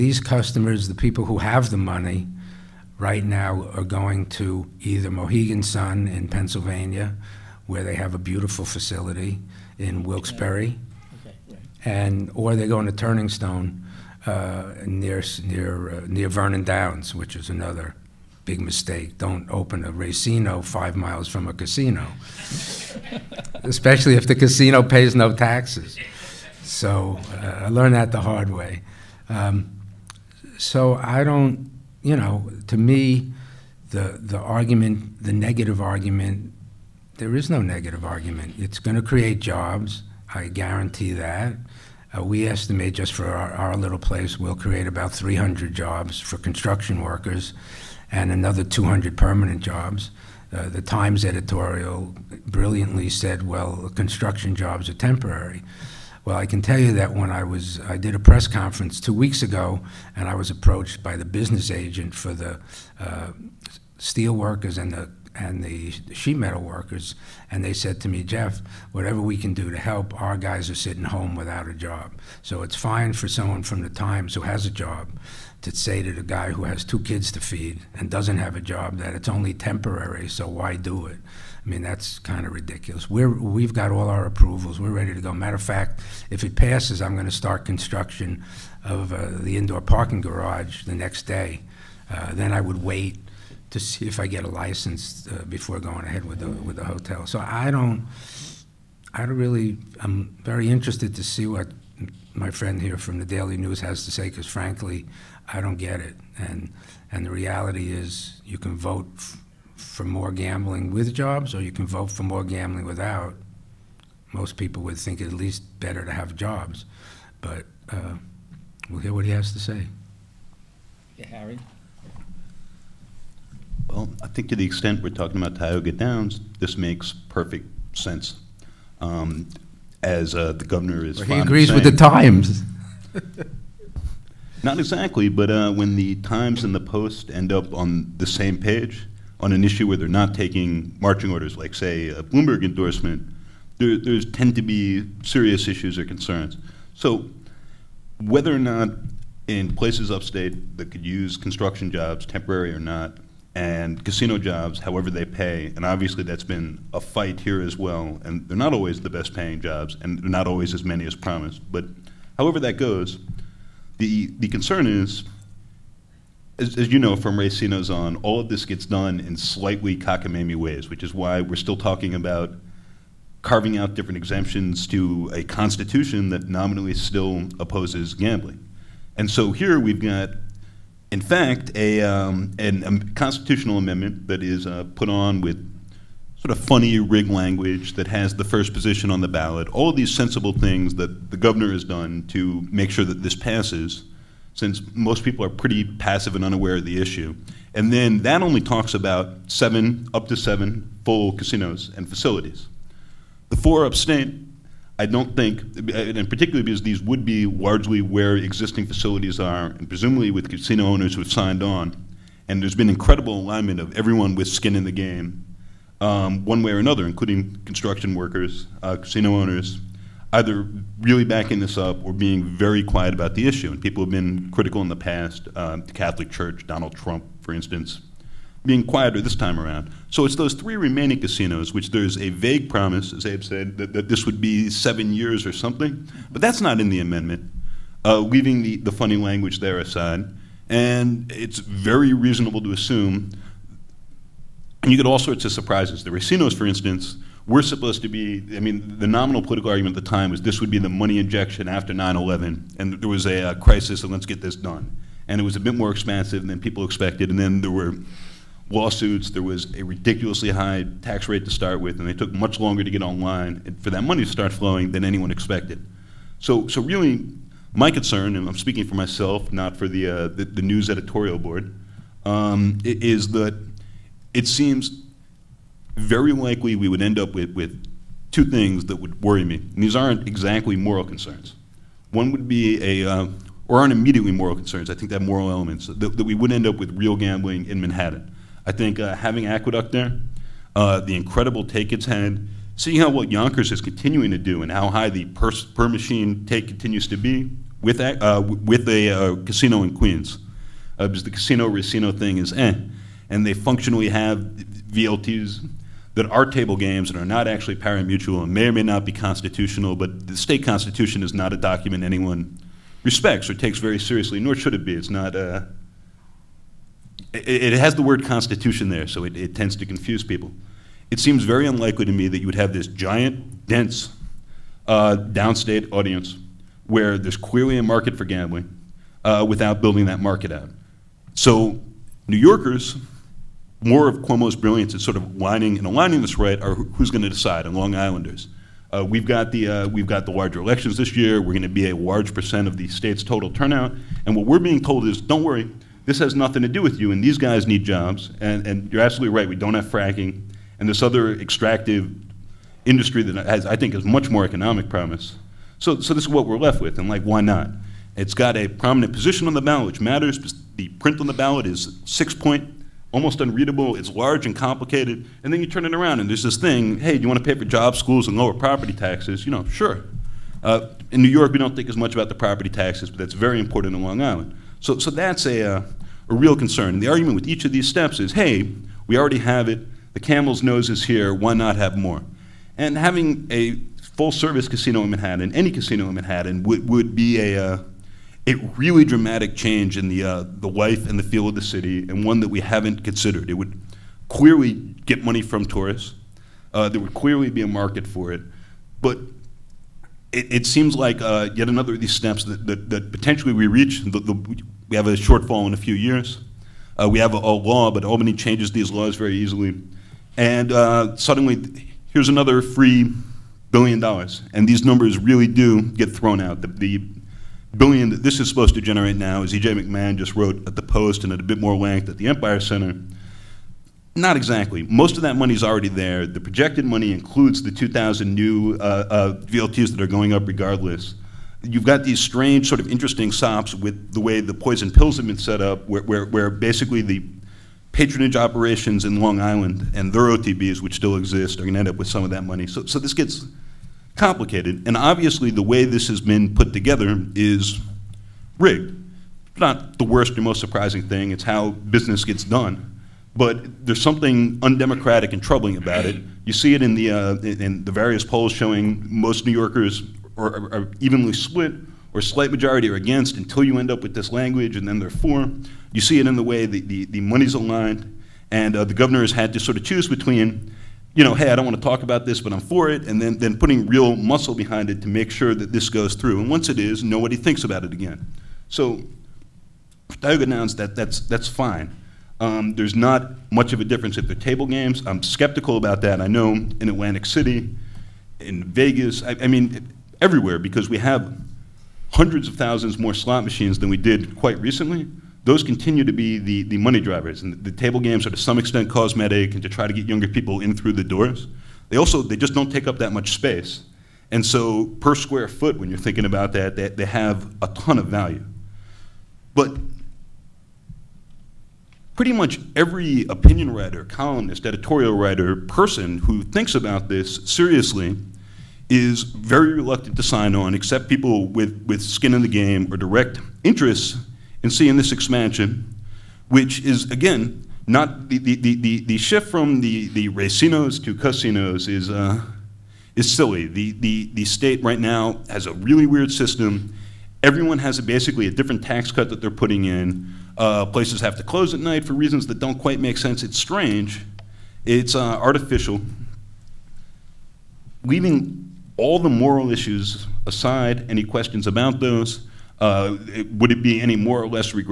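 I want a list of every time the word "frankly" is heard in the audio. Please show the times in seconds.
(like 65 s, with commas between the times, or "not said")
104 s.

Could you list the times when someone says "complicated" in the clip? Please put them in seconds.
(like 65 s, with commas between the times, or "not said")
364 s, 444 s.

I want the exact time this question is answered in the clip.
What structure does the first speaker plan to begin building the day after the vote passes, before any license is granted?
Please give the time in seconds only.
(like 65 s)
89 s.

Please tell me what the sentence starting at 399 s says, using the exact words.
But it, it seems like uh, yet another of these steps that, that, that potentially we reach.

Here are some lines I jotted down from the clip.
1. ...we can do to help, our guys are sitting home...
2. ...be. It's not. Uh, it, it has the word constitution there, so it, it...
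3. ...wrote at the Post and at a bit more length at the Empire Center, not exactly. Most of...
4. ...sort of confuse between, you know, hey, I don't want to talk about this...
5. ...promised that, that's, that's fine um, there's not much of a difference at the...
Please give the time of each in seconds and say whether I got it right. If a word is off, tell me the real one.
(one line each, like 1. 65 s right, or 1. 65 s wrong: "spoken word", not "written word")
1. 69 s right
2. 314 s right
3. 420 s right
4. 469 s wrong: "choose", not "confuse"
5. 480 s wrong: "announced", not "promised".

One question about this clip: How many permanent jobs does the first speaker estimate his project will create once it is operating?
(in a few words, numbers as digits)
200.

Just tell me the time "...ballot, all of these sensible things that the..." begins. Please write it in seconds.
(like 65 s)
189 s.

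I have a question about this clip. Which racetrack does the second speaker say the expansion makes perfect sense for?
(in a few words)
Tioga Downs.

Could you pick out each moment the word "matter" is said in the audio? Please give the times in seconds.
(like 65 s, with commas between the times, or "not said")
85 s, 360 s.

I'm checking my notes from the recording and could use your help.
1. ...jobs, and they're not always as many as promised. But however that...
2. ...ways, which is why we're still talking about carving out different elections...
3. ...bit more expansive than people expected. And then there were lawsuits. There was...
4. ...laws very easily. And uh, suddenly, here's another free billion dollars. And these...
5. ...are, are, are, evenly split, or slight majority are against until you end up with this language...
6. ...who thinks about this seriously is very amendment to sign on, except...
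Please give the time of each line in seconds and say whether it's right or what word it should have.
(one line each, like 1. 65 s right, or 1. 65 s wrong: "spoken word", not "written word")
1. 159 s right
2. 170 s wrong: "exemptions", not "elections"
3. 255 s right
4. 408 s right
5. 460 s right
6. 516 s wrong: "reluctant", not "amendment".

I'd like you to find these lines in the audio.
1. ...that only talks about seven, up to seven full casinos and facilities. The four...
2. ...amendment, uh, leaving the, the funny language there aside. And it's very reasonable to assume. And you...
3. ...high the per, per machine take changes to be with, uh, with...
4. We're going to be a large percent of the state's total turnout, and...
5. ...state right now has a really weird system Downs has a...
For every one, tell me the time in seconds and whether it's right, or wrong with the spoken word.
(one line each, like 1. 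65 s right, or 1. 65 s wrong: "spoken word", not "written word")
1. 198 s right
2. 237 s right
3. 294 s wrong: "continues", not "changes"
4. 341 s right
5. 534 s wrong: "Everyone", not "Downs".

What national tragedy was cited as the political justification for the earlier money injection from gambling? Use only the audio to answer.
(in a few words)
9/11.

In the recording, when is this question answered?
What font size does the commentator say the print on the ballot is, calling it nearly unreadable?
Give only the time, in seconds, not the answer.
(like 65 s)
362 s.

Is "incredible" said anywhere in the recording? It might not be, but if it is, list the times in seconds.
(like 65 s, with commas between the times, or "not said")
212 s, 291 s.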